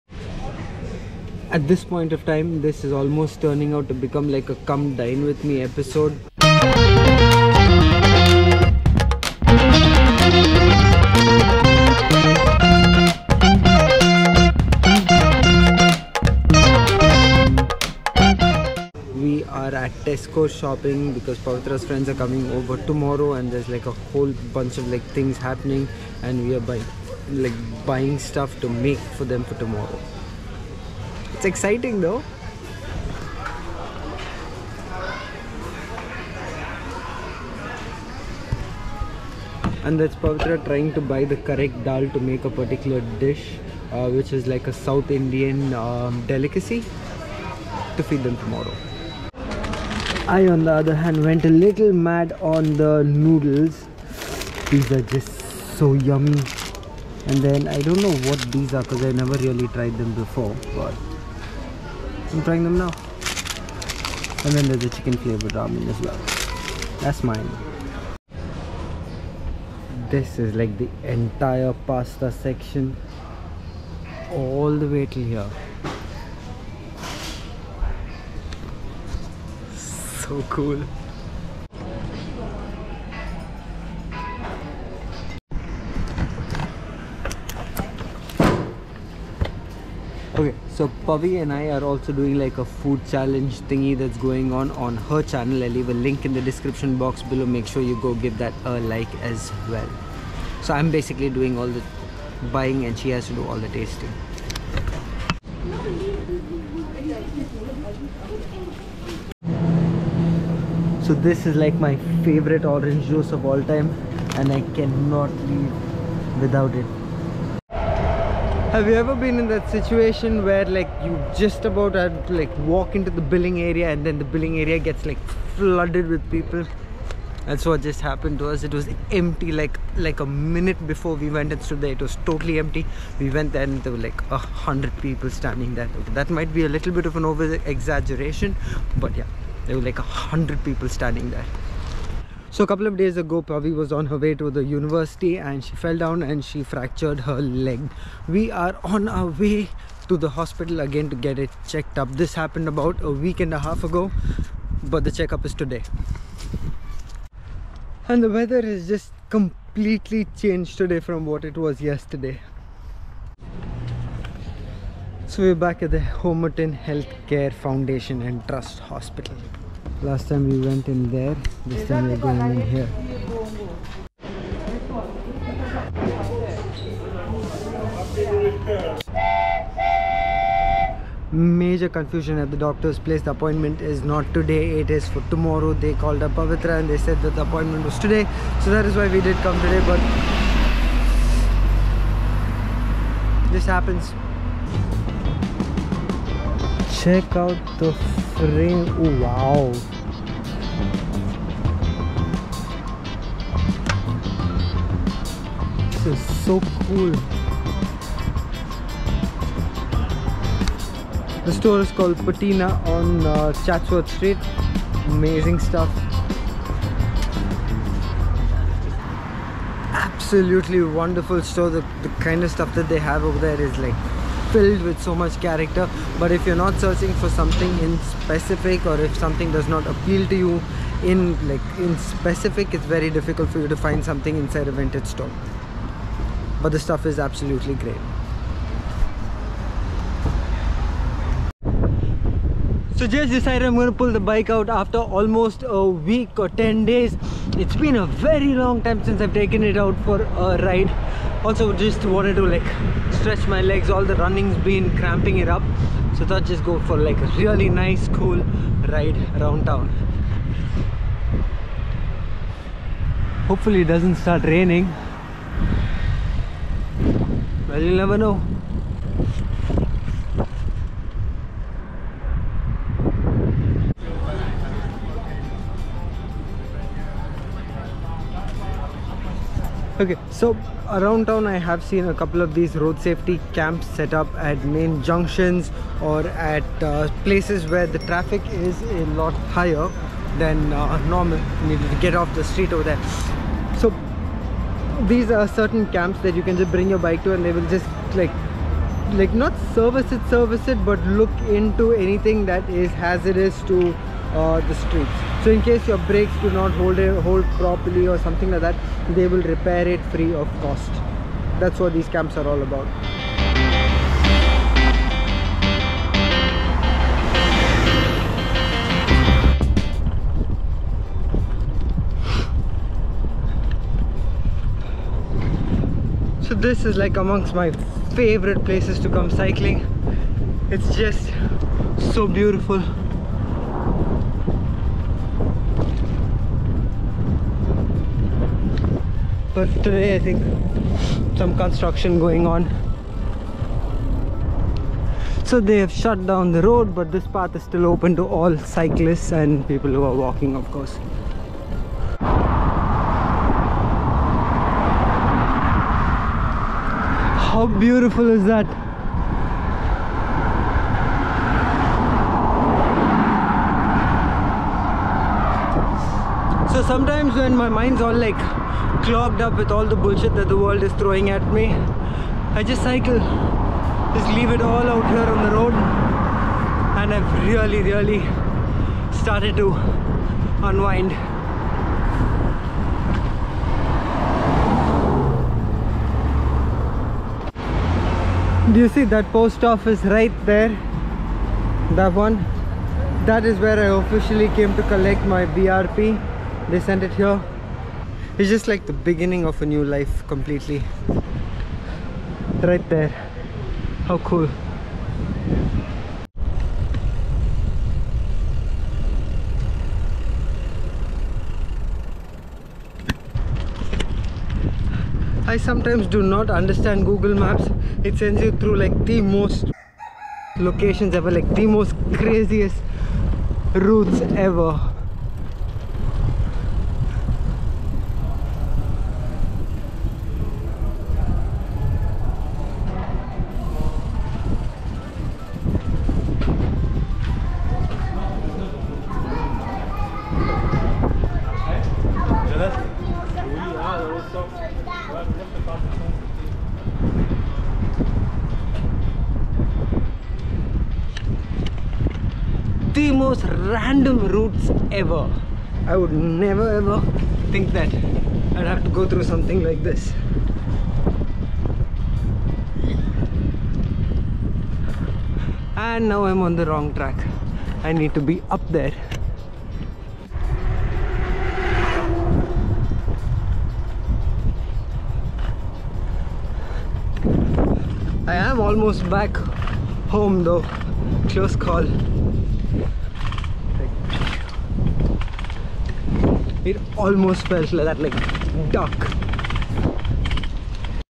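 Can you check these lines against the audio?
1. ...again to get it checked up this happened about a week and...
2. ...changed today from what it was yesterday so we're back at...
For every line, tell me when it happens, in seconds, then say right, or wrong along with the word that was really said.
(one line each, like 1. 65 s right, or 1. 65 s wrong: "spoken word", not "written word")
1. 150 s right
2. 160 s right.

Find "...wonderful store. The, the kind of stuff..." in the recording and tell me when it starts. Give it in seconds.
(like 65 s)
220 s.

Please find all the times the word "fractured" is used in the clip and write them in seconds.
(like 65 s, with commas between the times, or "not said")
146 s.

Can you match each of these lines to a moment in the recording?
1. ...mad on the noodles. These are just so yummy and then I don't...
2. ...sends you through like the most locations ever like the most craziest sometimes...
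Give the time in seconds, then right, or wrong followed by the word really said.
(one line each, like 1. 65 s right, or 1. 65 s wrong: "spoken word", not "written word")
1. 51 s right
2. 418 s wrong: "routes", not "sometimes".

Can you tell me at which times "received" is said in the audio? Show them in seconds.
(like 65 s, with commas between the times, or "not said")
not said.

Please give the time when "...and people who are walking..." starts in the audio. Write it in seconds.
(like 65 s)
349 s.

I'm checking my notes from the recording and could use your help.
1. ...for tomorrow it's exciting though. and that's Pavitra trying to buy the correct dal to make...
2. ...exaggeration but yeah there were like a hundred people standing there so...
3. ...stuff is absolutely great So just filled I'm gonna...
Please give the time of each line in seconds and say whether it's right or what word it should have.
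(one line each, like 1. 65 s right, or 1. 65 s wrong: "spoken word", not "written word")
1. 29 s right
2. 137 s right
3. 236 s wrong: "decided", not "filled".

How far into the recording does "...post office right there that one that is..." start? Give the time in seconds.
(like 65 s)
389 s.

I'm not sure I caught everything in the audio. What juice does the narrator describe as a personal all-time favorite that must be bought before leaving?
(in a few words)
Orange juice.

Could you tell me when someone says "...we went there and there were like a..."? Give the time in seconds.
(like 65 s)
133 s.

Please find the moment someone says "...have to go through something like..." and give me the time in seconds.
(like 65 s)
458 s.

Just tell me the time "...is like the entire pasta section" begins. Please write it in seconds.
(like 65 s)
70 s.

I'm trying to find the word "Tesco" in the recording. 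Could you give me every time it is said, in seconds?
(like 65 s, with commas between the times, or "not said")
20 s.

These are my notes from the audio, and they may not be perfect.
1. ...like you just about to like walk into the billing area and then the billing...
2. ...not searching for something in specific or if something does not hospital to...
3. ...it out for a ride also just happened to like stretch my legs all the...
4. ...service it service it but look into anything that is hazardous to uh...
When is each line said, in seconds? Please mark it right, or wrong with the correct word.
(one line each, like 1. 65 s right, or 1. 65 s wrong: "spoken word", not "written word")
1. 120 s right
2. 226 s wrong: "appeal", not "hospital"
3. 249 s wrong: "wanted", not "happened"
4. 299 s right.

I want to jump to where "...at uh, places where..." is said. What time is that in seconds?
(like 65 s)
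286 s.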